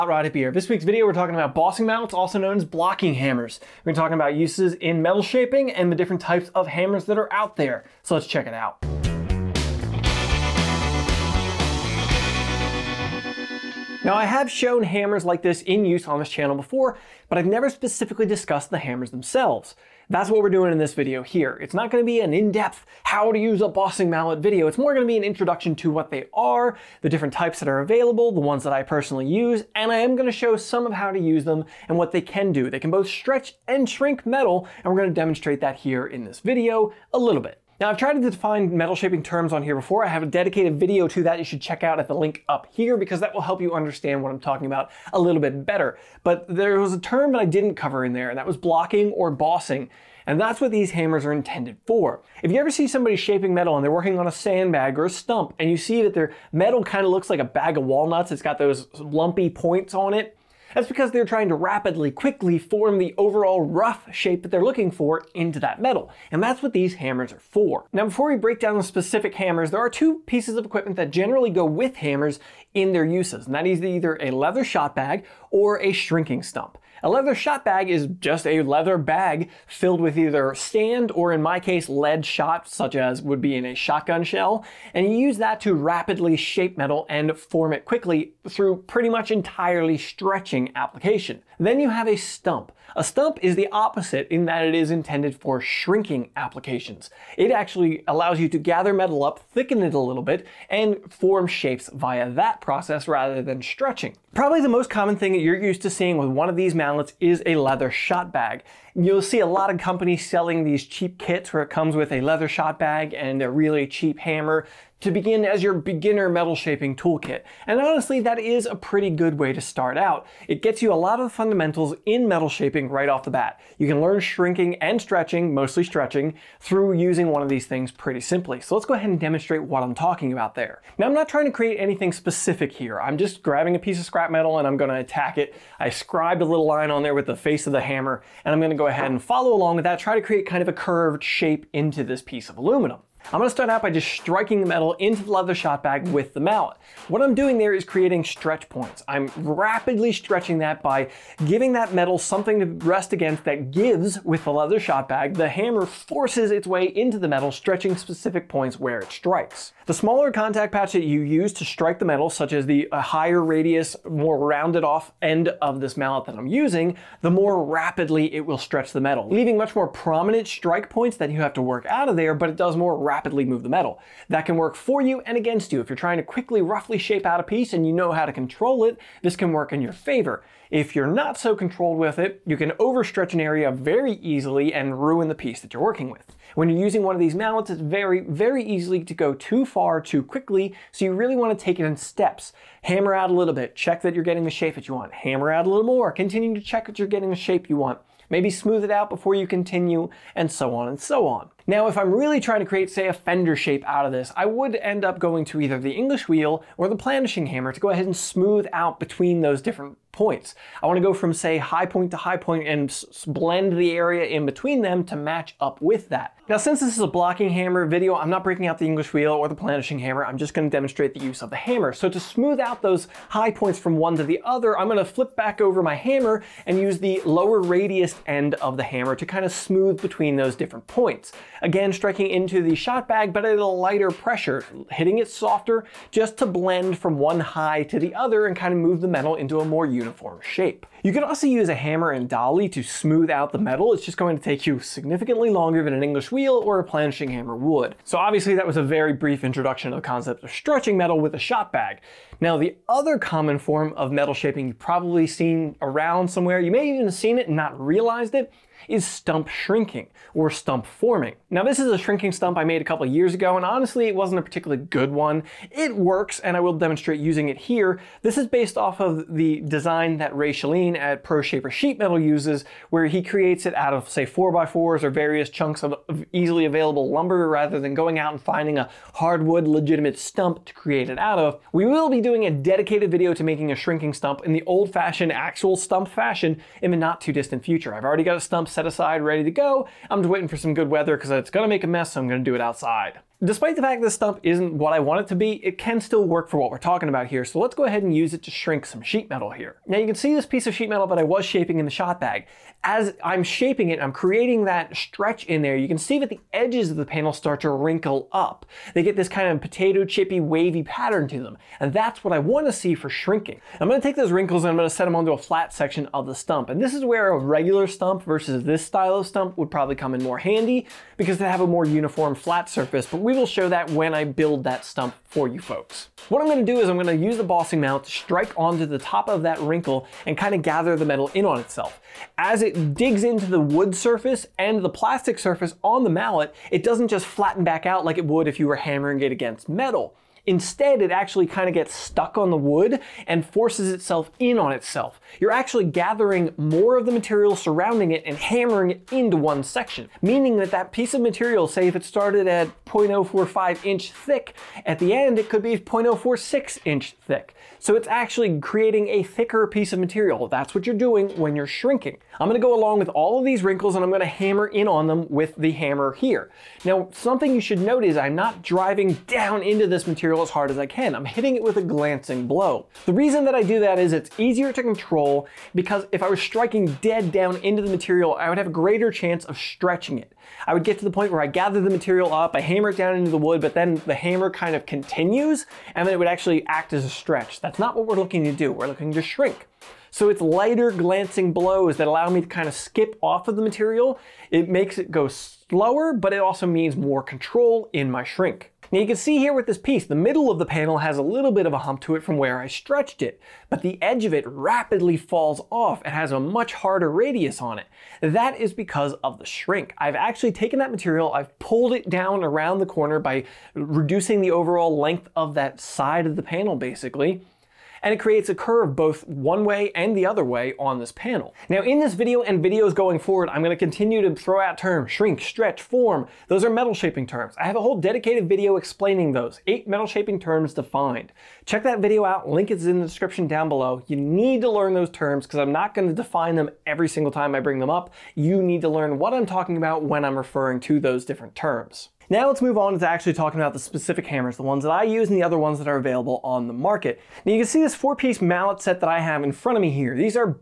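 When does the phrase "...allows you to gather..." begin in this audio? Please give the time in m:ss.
1:38.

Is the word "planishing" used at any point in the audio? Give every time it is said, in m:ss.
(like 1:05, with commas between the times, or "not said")
3:26, 3:39, 4:06.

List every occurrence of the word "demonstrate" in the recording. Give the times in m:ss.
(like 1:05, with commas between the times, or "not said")
0:35, 2:09, 3:40, 4:26.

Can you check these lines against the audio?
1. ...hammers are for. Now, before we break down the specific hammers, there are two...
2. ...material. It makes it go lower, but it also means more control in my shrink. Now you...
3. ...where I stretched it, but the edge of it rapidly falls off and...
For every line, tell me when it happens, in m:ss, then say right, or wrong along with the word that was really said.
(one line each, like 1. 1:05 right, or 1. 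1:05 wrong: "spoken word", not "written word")
1. 1:06 right
2. 6:33 wrong: "slower", not "lower"
3. 6:42 right.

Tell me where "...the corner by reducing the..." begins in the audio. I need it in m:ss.
6:52.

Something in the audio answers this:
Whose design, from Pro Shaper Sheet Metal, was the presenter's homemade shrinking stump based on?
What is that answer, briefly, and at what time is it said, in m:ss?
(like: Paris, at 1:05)
Wray Schelin, at 4:30.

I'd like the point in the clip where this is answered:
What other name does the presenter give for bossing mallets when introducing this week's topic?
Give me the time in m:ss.
0:02.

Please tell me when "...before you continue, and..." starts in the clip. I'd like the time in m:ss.
3:19.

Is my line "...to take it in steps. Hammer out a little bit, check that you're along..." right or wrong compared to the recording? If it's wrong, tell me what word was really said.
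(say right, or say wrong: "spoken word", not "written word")
wrong: "getting", not "along".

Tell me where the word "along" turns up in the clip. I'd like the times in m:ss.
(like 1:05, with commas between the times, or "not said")
2:19, 6:02.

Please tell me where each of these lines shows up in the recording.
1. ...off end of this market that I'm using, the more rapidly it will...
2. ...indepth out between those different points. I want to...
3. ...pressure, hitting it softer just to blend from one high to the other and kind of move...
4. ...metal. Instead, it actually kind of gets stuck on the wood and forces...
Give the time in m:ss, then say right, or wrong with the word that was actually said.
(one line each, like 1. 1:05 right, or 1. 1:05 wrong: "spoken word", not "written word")
1. 2:44 wrong: "mallet", not "market"
2. 3:28 wrong: "smooth", not "indepth"
3. 3:54 right
4. 5:39 right.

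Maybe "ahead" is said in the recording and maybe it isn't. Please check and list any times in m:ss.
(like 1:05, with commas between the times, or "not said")
2:08, 2:18, 3:27, 4:57.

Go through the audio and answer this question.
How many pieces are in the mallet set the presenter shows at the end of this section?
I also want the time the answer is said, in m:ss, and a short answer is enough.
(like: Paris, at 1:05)
4, at 7:27.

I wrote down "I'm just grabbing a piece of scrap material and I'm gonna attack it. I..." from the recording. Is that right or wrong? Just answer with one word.
wrong.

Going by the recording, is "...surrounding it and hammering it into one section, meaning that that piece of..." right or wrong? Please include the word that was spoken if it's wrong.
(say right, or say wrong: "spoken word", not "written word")
right.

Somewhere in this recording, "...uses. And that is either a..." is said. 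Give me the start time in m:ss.
1:13.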